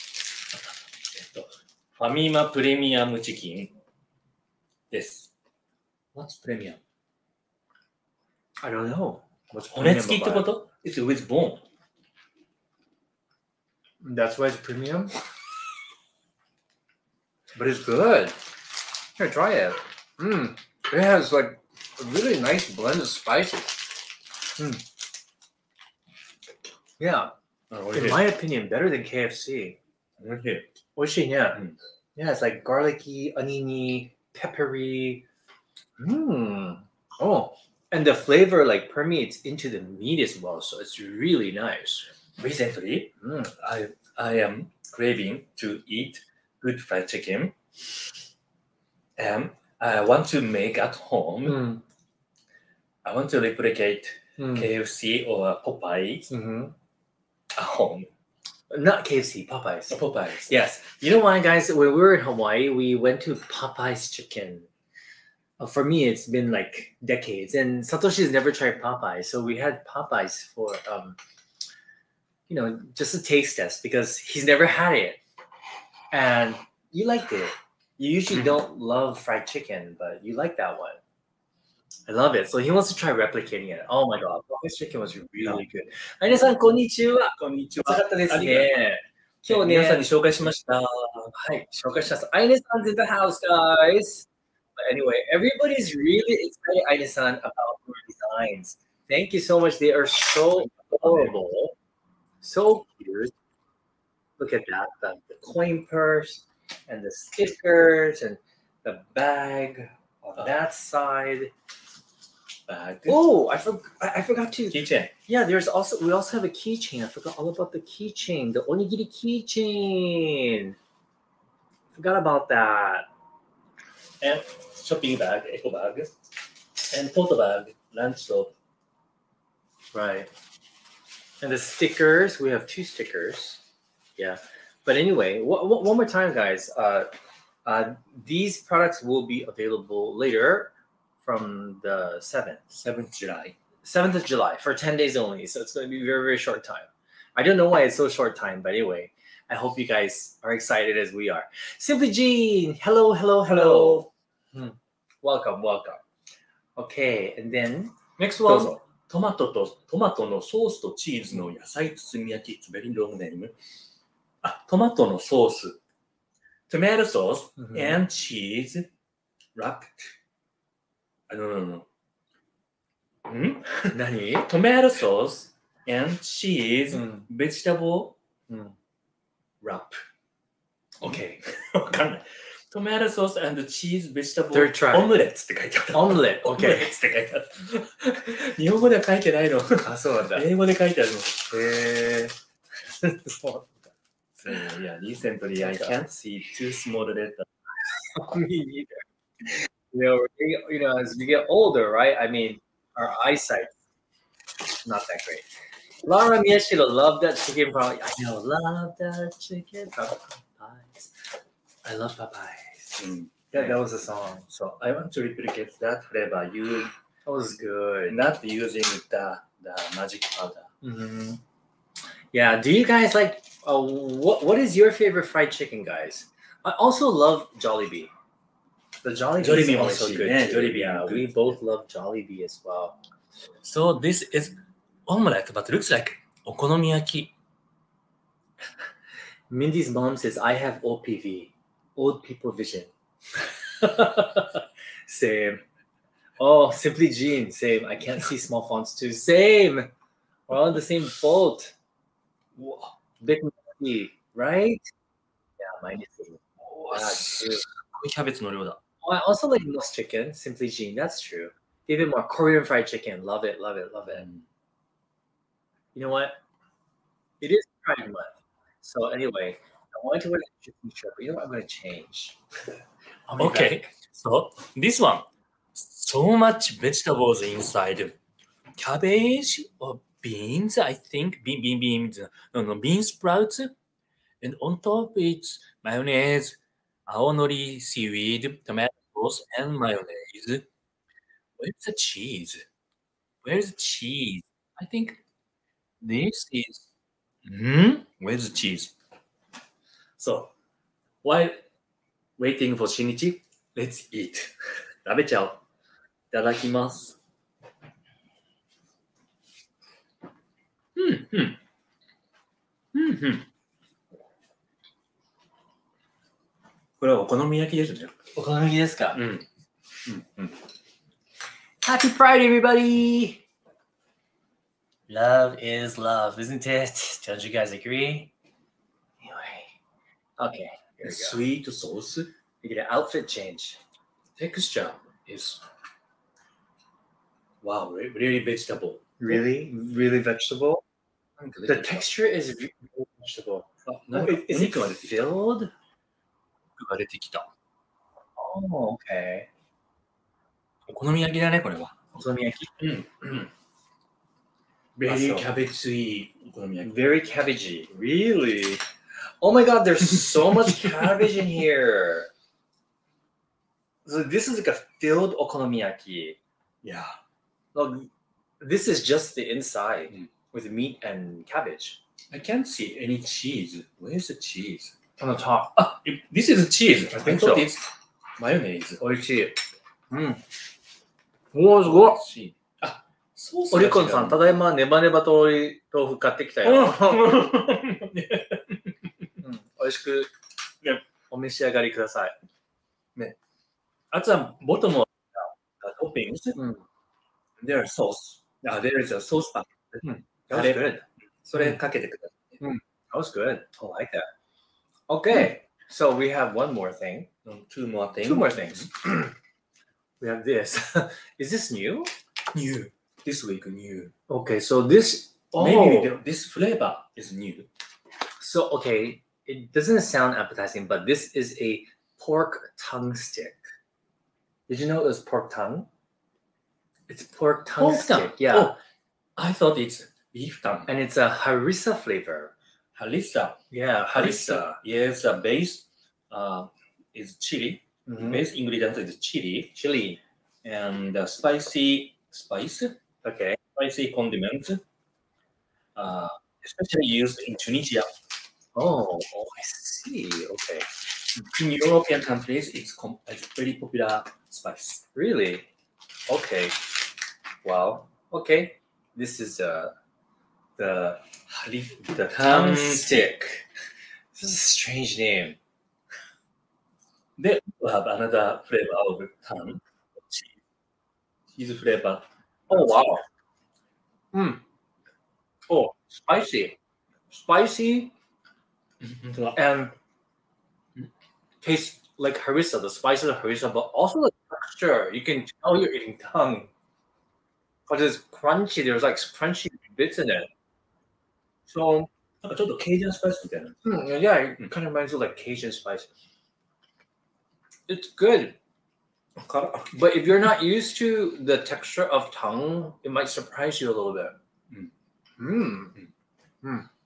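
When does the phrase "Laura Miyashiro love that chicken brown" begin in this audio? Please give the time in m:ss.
3:26.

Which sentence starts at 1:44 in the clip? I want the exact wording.
Look at that the, the coin purse and the stickers and the bag on oh.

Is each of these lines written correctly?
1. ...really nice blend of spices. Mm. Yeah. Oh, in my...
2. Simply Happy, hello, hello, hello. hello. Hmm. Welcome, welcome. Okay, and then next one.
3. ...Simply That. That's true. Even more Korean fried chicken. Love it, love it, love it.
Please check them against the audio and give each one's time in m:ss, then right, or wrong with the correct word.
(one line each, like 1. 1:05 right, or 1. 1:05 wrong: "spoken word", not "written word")
1. 0:22 right
2. 2:31 wrong: "Jean", not "Happy"
3. 4:20 wrong: "Jean", not "That".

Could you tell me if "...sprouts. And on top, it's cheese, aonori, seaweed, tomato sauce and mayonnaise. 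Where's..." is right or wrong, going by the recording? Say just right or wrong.
wrong.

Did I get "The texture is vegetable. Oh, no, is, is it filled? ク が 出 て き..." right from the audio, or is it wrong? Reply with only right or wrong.
right.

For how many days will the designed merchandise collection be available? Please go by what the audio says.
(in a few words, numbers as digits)
10.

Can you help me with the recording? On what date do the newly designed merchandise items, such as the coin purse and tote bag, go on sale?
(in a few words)
July 7.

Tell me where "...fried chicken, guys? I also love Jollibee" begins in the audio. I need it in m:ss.
3:45.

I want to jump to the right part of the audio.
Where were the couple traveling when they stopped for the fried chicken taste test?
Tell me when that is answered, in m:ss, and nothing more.
1:02.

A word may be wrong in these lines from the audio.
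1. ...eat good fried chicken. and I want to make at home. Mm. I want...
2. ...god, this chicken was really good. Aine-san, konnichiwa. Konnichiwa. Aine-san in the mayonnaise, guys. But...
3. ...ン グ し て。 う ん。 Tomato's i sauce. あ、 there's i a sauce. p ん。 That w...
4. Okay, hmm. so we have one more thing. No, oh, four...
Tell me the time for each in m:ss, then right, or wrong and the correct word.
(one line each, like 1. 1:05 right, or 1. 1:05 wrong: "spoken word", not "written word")
1. 0:45 right
2. 1:24 wrong: "house", not "mayonnaise"
3. 6:36 wrong: "There", not "Tomato"
4. 6:45 wrong: "two", not "four".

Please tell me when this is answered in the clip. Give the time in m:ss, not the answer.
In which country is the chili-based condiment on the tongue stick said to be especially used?
7:26.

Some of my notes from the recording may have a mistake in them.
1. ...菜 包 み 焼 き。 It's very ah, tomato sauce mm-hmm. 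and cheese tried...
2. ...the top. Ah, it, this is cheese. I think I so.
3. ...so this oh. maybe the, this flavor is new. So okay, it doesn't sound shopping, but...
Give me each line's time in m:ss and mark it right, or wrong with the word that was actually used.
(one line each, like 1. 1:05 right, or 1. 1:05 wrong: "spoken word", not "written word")
1. 2:41 wrong: "wrapped", not "tried"
2. 6:15 right
3. 6:54 wrong: "appetizing", not "shopping".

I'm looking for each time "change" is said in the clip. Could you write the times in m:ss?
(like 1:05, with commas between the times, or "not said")
4:31, 5:33.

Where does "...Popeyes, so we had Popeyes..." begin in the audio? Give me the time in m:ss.
1:08.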